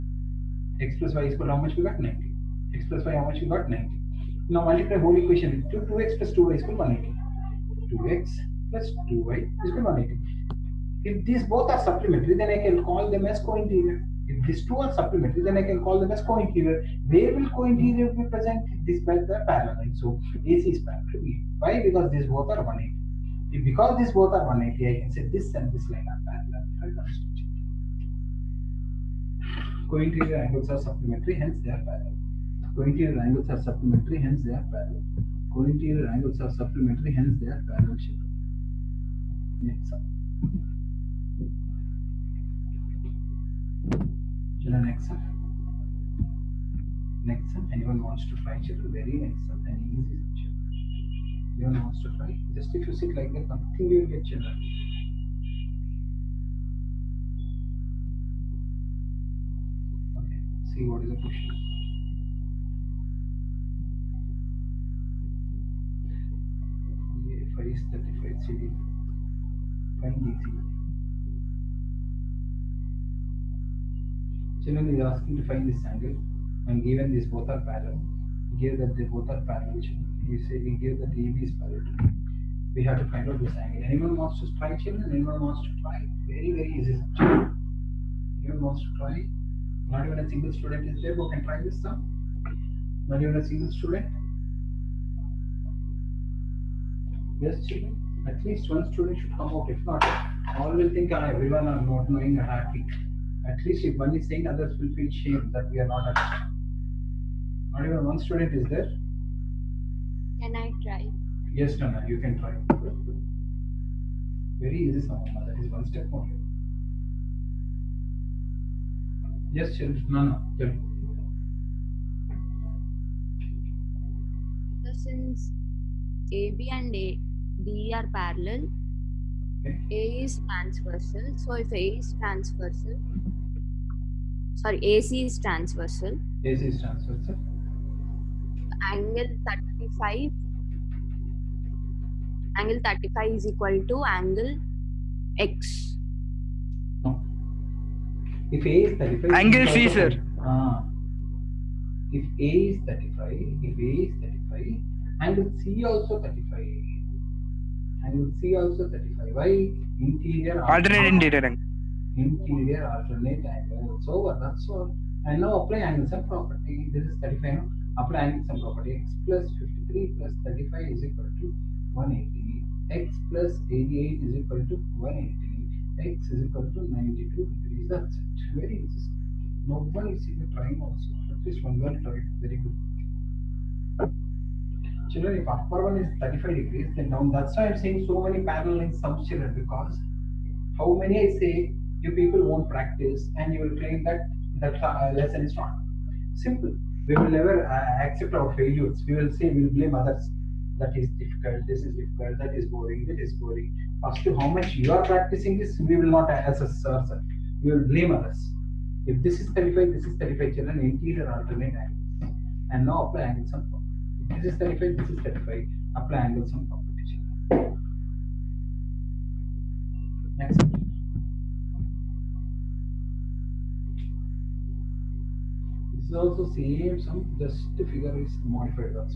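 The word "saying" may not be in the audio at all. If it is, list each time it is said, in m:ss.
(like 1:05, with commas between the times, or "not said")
1:44, 3:07.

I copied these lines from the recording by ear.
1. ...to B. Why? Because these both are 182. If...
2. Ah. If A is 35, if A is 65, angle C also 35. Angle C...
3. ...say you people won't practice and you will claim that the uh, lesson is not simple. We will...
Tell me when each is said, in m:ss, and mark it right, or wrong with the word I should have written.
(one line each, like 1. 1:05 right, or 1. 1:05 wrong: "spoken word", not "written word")
1. 0:21 wrong: "180", not "182"
2. 2:30 wrong: "35", not "65"
3. 3:11 right.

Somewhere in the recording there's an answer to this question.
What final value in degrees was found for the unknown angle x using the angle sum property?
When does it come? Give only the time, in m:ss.
2:56.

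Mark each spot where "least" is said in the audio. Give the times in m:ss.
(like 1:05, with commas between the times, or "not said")
1:38, 1:43, 3:01.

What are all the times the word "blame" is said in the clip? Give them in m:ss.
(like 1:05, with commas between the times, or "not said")
3:19, 3:27.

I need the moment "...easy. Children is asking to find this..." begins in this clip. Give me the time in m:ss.
1:10.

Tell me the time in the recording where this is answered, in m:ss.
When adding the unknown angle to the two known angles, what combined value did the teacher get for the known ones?
2:52.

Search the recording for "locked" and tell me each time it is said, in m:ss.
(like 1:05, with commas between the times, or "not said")
not said.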